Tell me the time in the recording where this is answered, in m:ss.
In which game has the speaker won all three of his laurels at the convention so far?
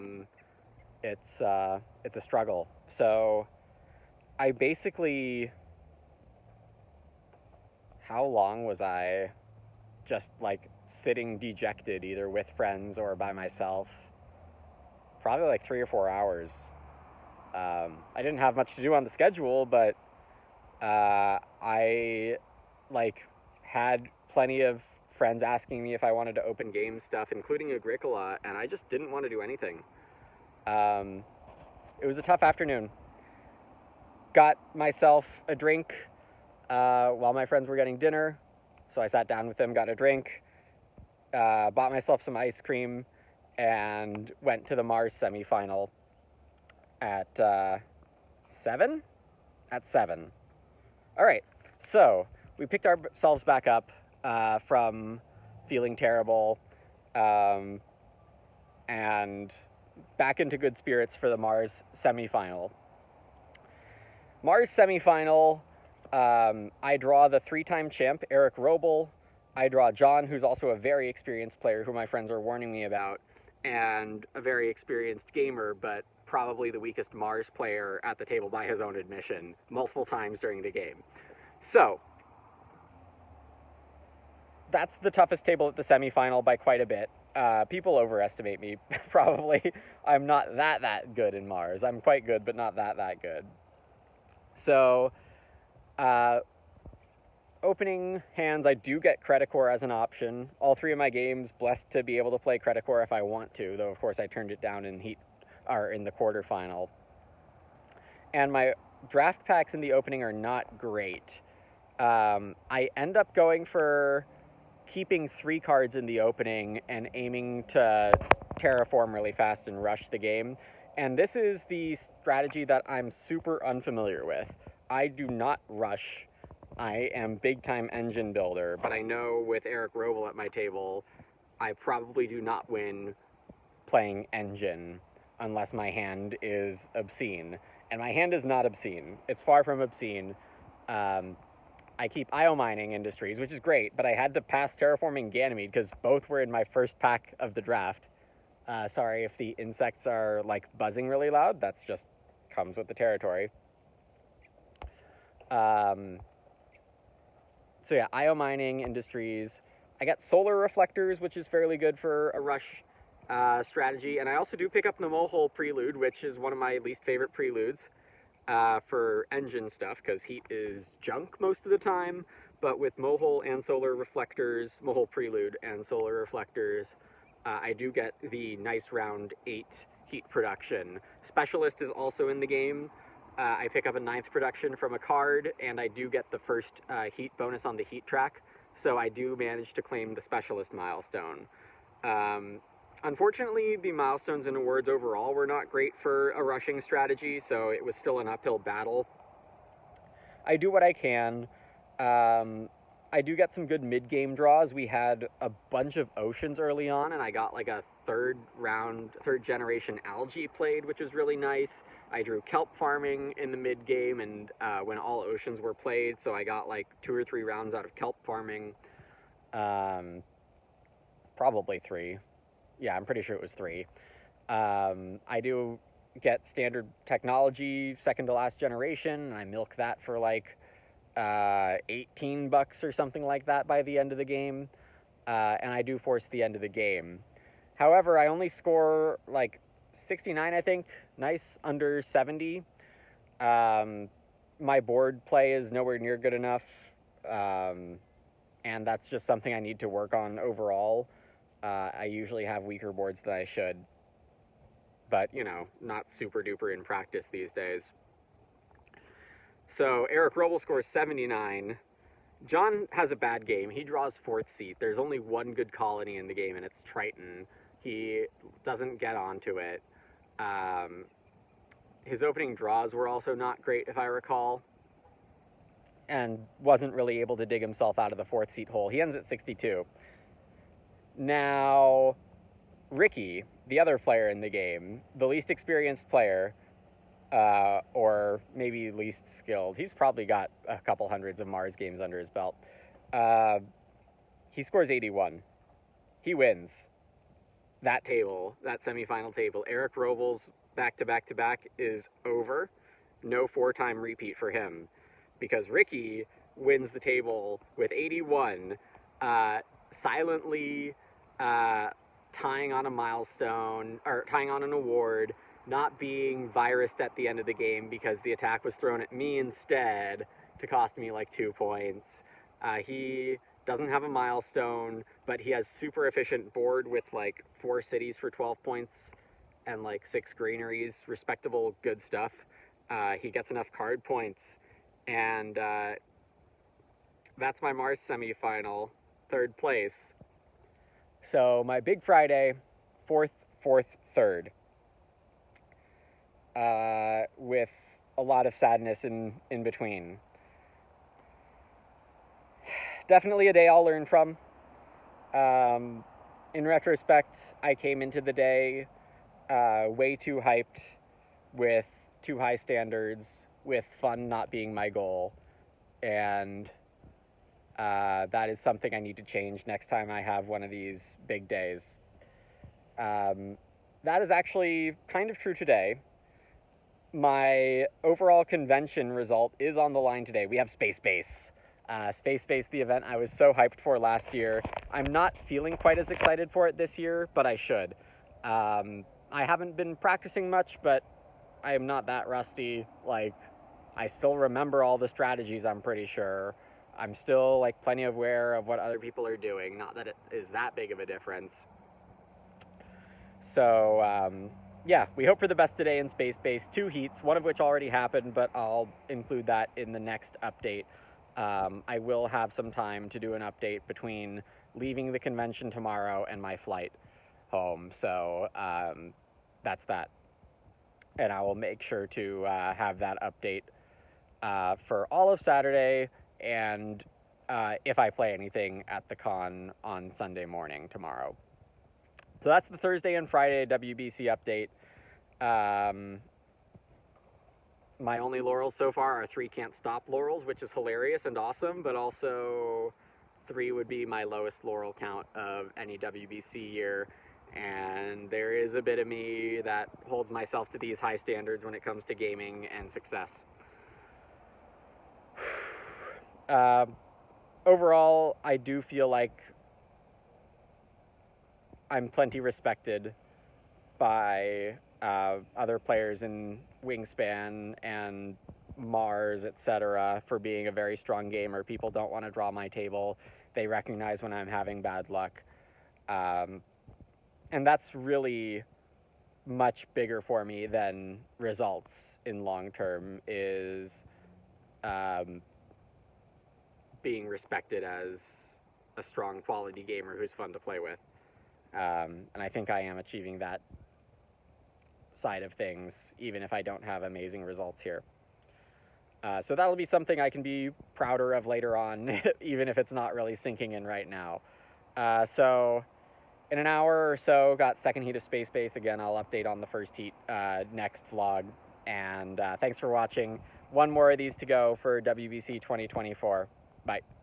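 7:19.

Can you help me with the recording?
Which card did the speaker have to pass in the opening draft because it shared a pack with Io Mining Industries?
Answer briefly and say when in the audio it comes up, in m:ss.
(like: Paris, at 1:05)
Terraforming Ganymede, at 2:24.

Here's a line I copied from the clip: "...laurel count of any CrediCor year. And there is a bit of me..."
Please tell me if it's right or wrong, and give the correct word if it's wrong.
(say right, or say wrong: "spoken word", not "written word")
wrong: "WBC", not "CrediCor".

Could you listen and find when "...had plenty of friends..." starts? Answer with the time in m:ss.
0:23.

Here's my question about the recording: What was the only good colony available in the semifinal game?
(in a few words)
Triton.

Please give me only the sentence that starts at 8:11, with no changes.
Um, and I think I am achieving that side of things, even if I don't have amazing results here.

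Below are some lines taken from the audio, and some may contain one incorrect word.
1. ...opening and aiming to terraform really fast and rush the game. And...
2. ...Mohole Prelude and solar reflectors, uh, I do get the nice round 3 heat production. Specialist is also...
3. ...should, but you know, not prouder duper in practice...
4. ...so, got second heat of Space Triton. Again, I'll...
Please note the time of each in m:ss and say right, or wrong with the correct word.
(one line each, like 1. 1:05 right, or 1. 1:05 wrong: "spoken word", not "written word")
1. 1:56 right
2. 2:54 wrong: "8", not "3"
3. 4:13 wrong: "super", not "prouder"
4. 8:27 wrong: "Base", not "Triton".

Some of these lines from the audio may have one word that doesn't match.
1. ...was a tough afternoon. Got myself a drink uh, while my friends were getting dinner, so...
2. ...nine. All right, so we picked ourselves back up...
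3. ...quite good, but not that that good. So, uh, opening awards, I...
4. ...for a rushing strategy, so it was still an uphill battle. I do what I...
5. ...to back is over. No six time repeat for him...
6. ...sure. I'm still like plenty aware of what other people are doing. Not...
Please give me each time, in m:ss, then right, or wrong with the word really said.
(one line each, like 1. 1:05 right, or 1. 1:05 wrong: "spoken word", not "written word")
1. 0:32 right
2. 0:49 wrong: "seven", not "nine"
3. 1:32 wrong: "hands", not "awards"
4. 3:16 right
5. 5:01 wrong: "four", not "six"
6. 6:36 right.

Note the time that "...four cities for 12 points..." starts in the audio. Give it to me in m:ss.
5:27.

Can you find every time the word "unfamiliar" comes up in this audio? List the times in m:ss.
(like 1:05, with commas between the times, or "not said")
2:03.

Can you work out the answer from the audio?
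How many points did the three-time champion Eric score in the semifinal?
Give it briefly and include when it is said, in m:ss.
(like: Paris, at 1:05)
79, at 4:20.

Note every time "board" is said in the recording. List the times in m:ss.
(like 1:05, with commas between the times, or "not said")
4:04, 4:12, 5:26.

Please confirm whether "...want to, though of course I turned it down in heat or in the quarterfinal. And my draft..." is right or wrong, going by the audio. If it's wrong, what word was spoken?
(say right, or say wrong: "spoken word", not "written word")
right.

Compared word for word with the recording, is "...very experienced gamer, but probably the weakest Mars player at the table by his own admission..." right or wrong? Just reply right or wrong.
right.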